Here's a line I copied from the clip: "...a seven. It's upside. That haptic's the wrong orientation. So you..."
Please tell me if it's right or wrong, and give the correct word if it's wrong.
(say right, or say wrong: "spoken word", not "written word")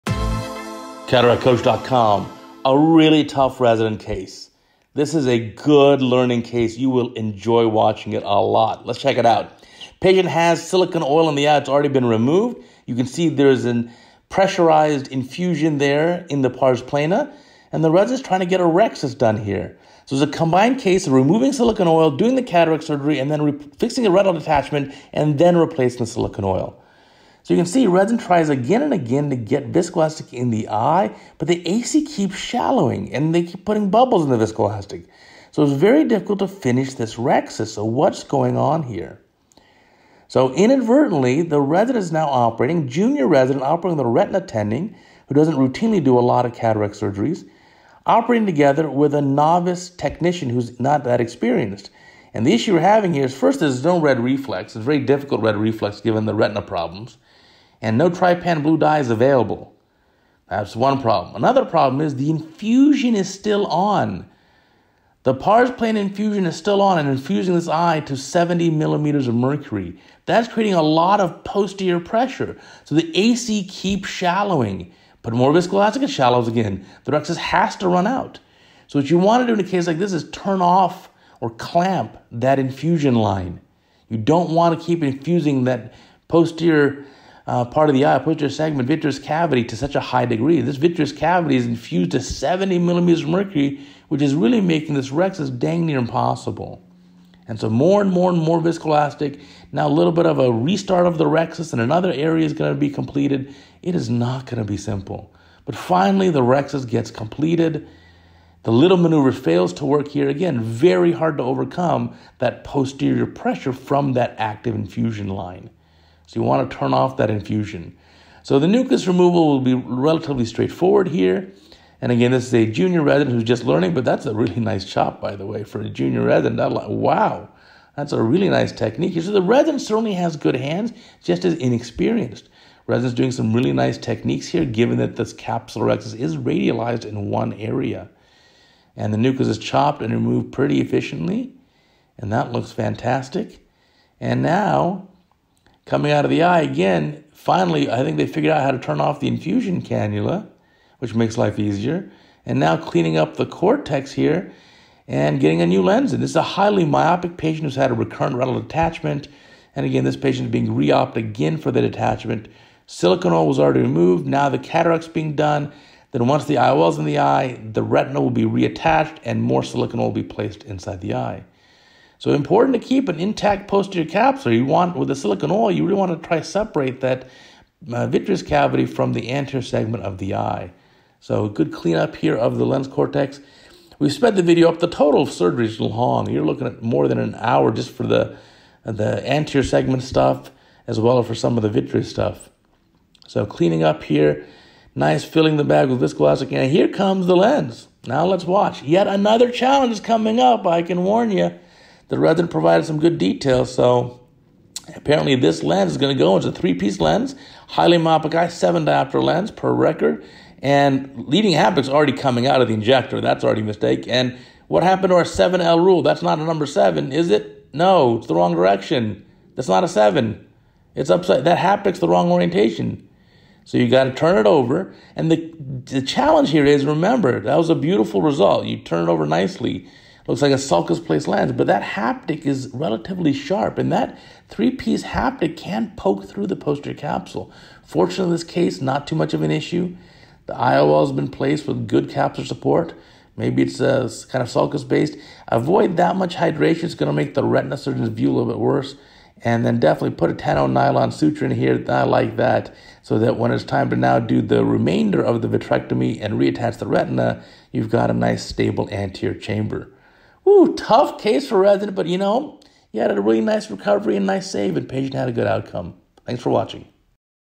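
right.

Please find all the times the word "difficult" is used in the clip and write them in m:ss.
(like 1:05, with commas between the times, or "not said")
0:36, 0:54.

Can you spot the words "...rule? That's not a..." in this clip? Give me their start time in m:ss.
3:35.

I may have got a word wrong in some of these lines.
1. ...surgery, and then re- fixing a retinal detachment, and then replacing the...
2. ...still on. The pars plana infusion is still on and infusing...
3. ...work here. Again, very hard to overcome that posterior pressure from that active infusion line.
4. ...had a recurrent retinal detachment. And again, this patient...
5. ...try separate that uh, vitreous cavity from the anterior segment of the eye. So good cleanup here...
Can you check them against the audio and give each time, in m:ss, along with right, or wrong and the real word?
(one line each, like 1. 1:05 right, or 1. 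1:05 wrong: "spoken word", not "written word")
1. 0:22 right
2. 1:03 right
3. 1:49 right
4. 2:37 right
5. 2:56 right.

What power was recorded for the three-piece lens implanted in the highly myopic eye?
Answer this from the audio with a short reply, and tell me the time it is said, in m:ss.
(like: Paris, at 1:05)
7 diopters, at 3:28.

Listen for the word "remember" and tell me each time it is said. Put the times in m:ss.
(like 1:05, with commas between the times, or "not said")
3:46.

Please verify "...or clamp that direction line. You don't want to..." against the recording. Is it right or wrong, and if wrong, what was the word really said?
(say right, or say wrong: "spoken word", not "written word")
wrong: "infusion", not "direction".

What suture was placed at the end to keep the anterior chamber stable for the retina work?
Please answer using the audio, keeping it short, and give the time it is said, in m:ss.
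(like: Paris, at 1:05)
10 nylon, at 4:10.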